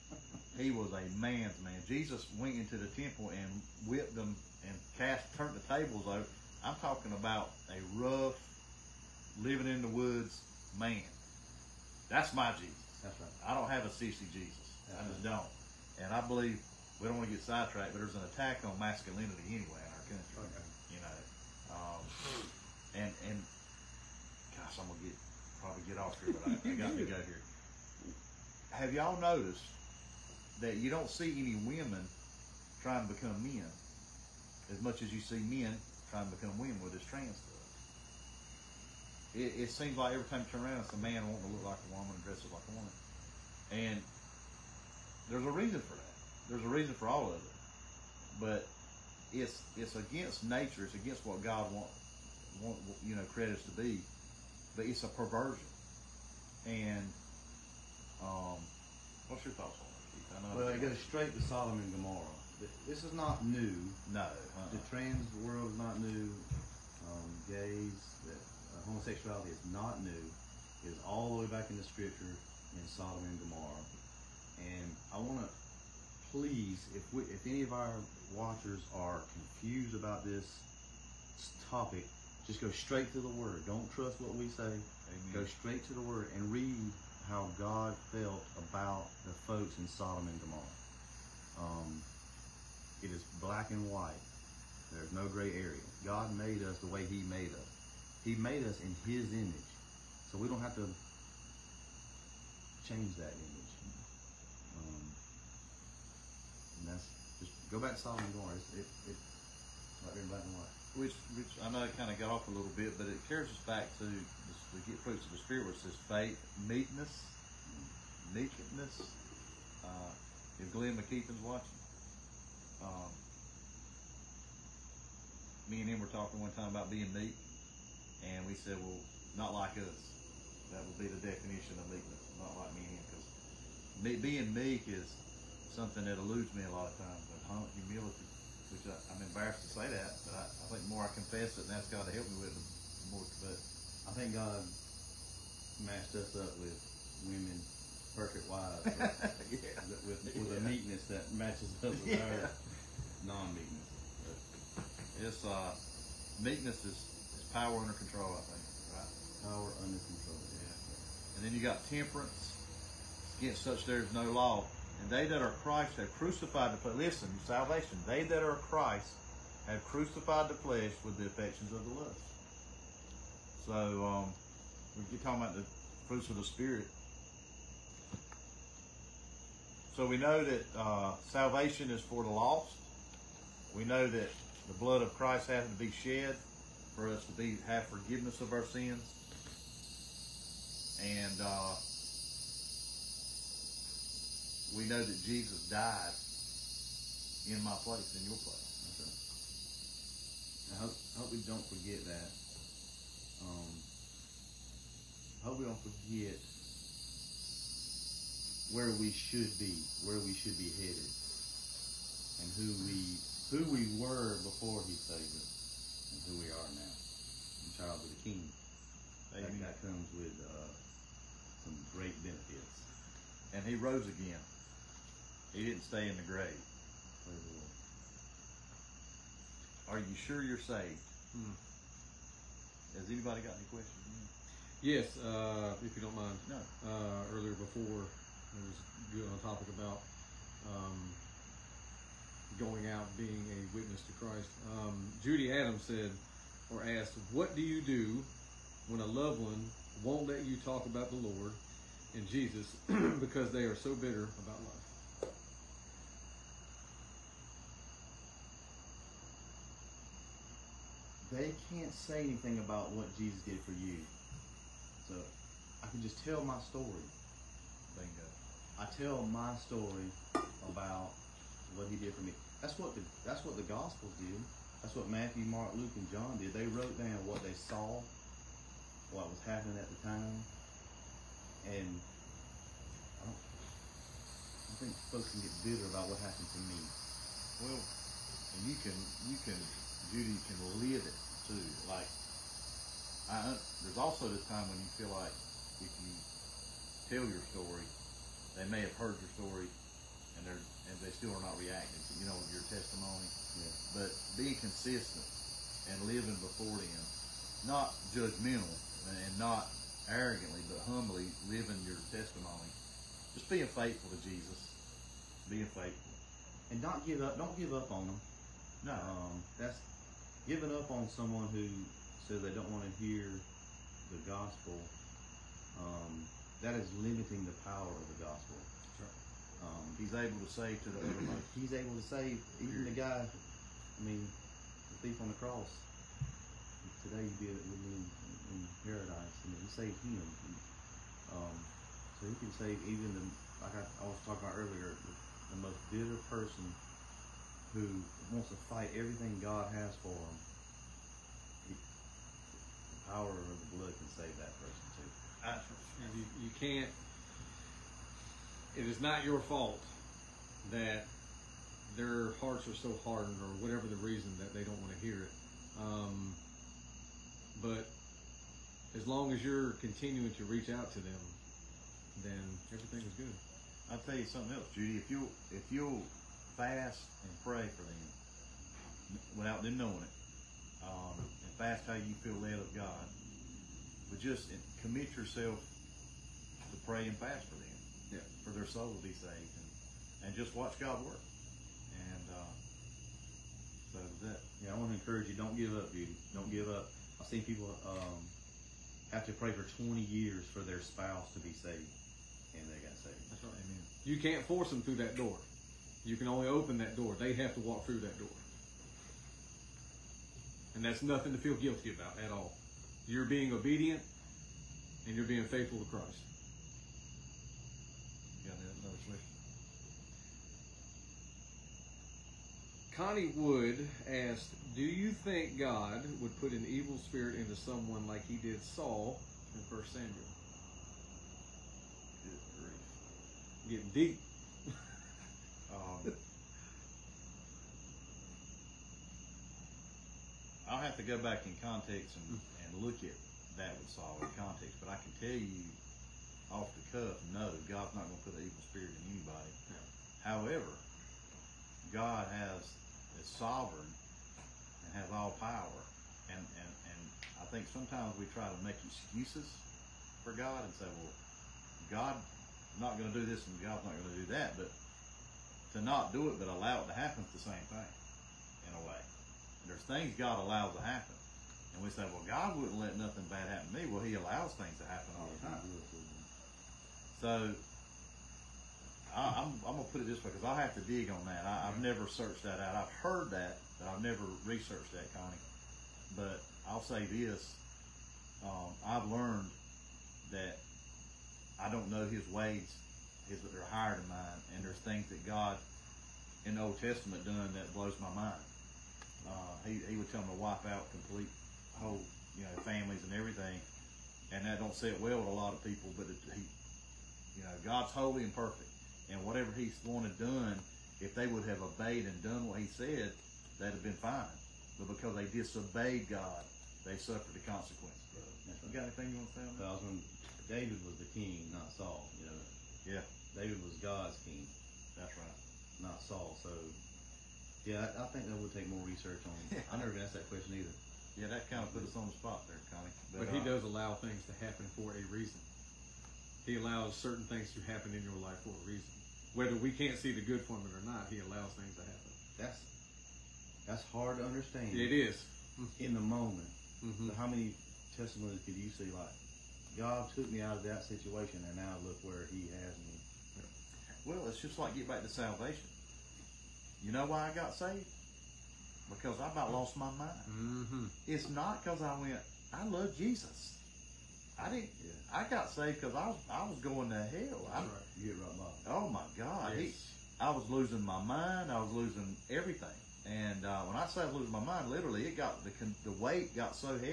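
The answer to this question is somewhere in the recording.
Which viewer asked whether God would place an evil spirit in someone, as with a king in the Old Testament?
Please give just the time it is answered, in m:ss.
7:02.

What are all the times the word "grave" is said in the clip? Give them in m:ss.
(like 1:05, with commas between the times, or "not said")
3:46.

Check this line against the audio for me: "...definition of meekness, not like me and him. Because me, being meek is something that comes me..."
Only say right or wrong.
wrong.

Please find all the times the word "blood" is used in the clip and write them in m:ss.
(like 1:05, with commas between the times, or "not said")
3:04, 5:53.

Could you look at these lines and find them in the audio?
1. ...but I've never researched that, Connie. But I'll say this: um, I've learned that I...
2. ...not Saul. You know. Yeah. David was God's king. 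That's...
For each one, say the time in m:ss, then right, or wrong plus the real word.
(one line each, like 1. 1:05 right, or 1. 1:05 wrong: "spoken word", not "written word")
1. 8:03 right
2. 8:41 right.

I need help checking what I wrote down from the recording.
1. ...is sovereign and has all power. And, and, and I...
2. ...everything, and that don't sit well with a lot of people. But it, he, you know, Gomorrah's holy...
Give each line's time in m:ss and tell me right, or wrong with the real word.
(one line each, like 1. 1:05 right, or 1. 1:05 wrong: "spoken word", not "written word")
1. 7:33 right
2. 8:23 wrong: "God", not "Gomorrah".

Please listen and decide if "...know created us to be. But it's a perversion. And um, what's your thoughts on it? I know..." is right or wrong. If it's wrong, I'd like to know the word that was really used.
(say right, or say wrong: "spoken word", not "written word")
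right.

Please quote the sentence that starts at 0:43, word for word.
And there's a reason for that.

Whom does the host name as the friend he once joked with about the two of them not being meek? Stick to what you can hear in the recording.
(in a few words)
Glenn McKeithen.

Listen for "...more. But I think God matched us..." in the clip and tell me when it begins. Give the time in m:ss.
2:23.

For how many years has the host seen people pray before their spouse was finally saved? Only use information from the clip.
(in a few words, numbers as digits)
20.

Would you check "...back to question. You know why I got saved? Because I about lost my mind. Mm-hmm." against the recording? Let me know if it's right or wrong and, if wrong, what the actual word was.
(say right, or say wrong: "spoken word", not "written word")
wrong: "salvation", not "question".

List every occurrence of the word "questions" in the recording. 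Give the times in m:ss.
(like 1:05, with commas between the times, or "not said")
3:53, 8:50.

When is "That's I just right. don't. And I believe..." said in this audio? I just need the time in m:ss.
0:14.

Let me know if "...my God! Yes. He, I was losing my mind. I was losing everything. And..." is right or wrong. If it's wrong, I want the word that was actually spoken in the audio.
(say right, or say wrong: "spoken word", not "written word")
right.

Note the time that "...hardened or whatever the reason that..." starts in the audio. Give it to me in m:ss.
6:03.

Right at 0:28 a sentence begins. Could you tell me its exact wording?
Have y'all noticed that you don't see any women trying to become men?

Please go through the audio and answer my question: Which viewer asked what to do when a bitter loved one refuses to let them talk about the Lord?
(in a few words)
Judy Adams.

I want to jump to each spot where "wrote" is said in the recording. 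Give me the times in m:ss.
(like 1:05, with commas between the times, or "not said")
4:36.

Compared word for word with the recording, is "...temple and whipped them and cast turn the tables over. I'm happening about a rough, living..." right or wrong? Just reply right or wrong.
wrong.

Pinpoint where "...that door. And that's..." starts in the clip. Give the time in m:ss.
6:48.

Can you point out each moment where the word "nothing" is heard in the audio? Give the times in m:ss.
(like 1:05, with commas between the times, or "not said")
6:51, 7:52.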